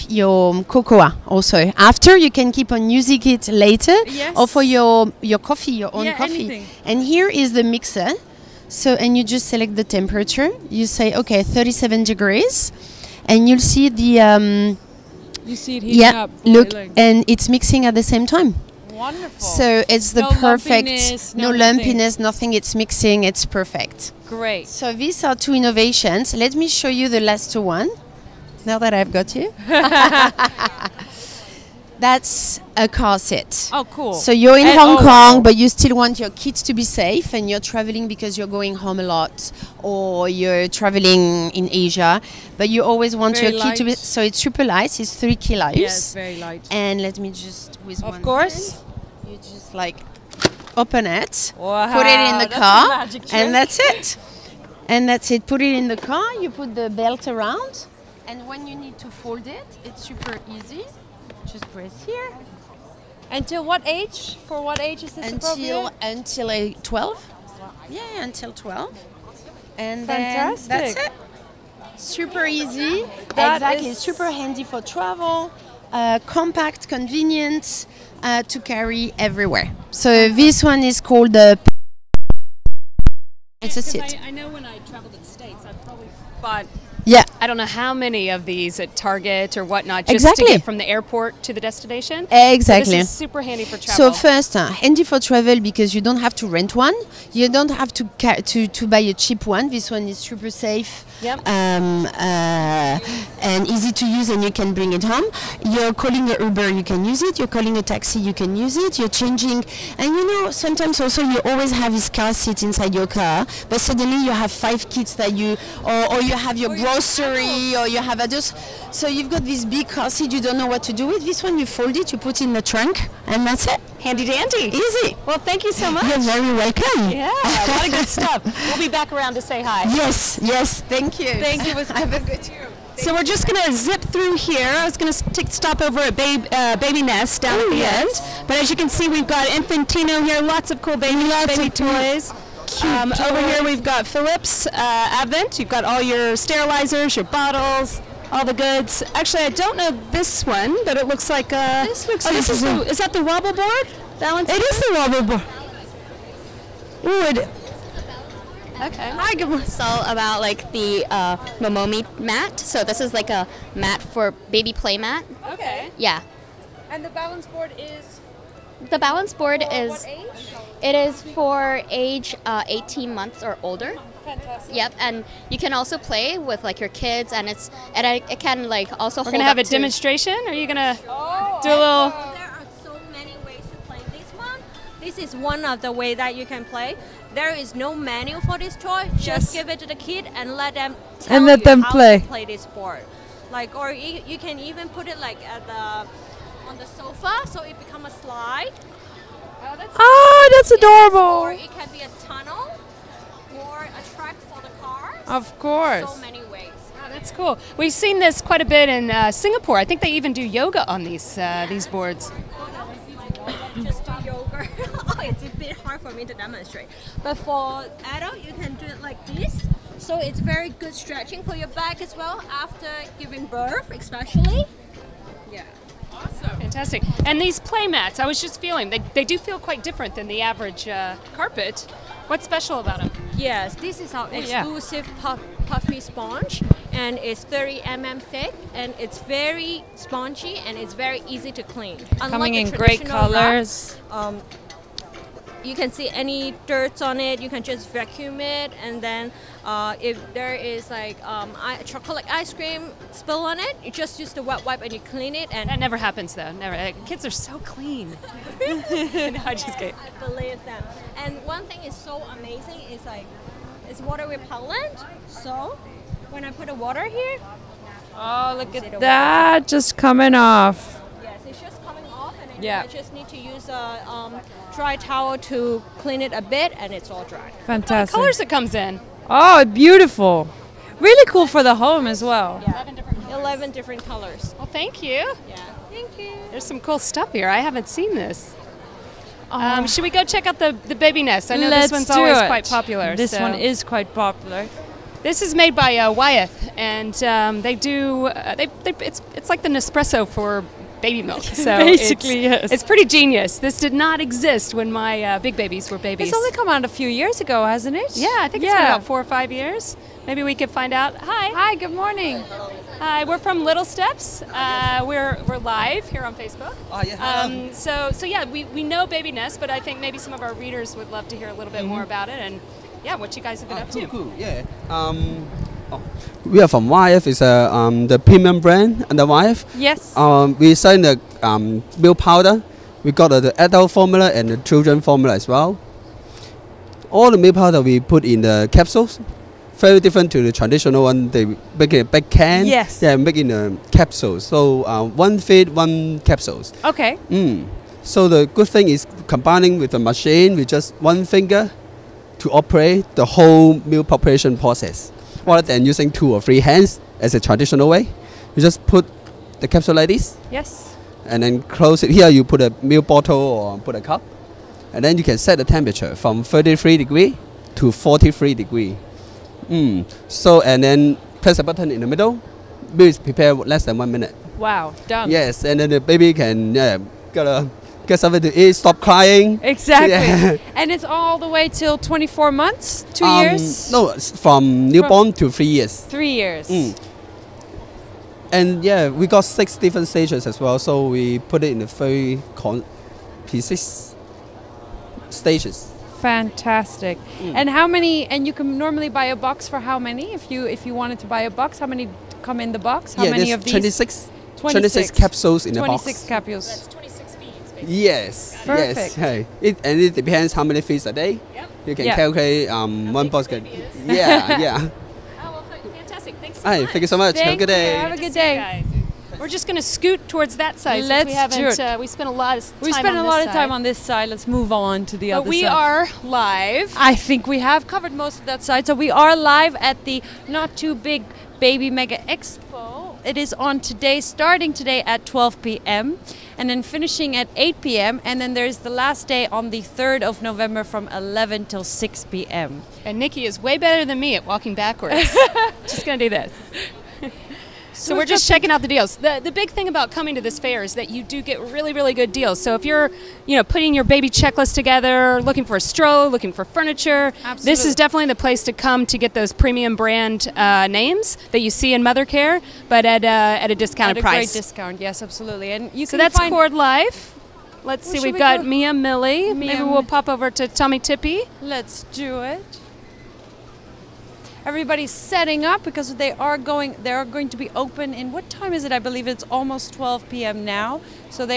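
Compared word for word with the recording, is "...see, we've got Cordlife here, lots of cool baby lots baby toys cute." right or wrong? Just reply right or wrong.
wrong.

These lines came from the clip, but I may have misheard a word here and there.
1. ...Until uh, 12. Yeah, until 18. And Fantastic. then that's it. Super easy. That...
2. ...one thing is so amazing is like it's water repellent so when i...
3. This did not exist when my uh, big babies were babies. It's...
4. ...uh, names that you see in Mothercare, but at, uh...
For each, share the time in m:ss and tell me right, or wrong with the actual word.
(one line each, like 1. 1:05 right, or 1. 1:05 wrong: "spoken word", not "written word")
1. 1:05 wrong: "12", not "18"
2. 4:21 right
3. 5:03 right
4. 7:40 right.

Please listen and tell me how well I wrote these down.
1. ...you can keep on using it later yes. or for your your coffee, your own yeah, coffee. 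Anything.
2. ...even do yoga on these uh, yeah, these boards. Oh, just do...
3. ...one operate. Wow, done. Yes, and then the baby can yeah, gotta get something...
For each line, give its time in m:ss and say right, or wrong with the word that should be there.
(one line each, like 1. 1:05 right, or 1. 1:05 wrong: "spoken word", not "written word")
1. 0:02 right
2. 3:30 right
3. 6:13 wrong: "minute", not "operate".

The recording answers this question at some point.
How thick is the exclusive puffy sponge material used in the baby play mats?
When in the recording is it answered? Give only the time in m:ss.
3:57.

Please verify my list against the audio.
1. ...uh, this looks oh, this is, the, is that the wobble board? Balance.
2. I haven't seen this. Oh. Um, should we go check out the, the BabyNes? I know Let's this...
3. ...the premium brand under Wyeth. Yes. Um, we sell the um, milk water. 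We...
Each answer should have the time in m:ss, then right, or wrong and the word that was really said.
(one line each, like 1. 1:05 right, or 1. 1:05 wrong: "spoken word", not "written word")
1. 2:31 right
2. 4:47 right
3. 5:28 wrong: "powder", not "water".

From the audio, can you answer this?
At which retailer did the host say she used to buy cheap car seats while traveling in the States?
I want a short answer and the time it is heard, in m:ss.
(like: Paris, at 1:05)
Target, at 1:28.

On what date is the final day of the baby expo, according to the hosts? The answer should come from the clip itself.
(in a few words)
3rd of November.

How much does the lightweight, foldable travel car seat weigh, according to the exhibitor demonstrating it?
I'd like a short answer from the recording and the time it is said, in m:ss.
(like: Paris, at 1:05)
3 kilos, at 0:45.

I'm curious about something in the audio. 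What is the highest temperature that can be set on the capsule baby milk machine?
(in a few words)
43 degrees.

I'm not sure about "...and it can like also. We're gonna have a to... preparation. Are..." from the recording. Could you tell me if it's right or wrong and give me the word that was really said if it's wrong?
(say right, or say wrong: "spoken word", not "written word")
wrong: "demonstration", not "preparation".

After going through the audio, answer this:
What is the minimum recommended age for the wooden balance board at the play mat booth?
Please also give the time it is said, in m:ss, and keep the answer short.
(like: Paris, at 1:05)
18 months, at 2:52.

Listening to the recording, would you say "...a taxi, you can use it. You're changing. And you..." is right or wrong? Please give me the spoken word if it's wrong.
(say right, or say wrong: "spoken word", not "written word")
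right.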